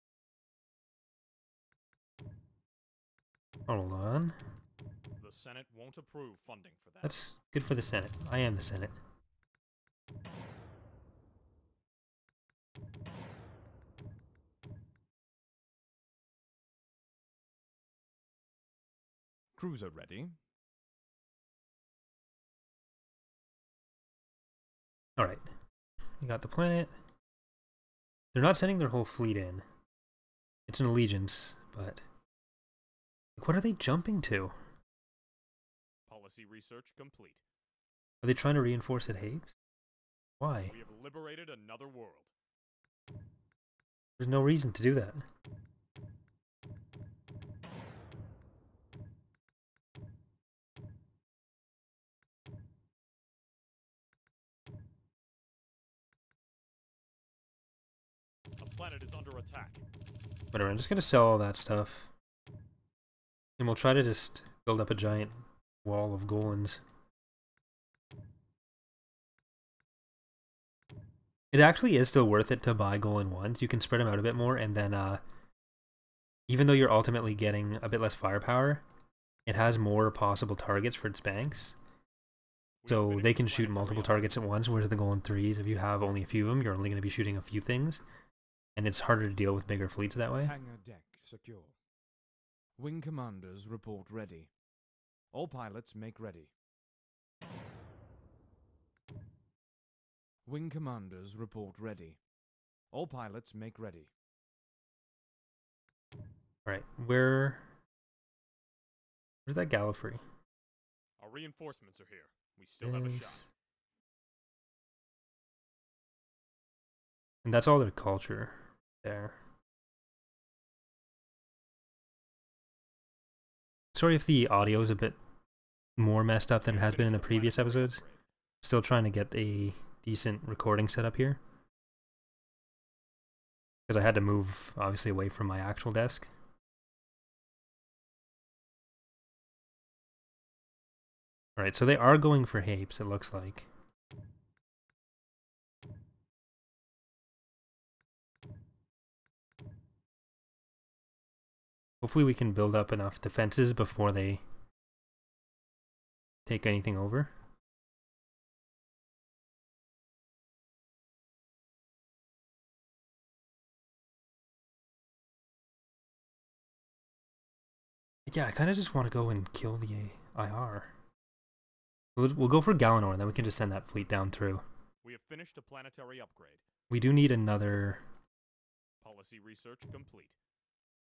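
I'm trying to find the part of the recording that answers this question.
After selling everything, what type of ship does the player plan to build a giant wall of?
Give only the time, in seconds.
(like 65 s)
66 s.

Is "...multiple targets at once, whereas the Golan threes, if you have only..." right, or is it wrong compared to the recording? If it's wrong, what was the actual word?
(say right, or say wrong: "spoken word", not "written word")
right.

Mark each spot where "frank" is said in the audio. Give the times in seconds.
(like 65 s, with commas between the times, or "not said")
not said.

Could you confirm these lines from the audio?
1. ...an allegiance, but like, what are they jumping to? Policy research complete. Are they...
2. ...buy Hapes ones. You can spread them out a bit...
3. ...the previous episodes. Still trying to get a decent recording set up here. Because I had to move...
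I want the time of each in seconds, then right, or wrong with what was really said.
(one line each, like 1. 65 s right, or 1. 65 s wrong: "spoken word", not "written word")
1. 30 s right
2. 72 s wrong: "Golan", not "Hapes"
3. 127 s right.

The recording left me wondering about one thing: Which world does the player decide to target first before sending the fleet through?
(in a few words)
Galanor.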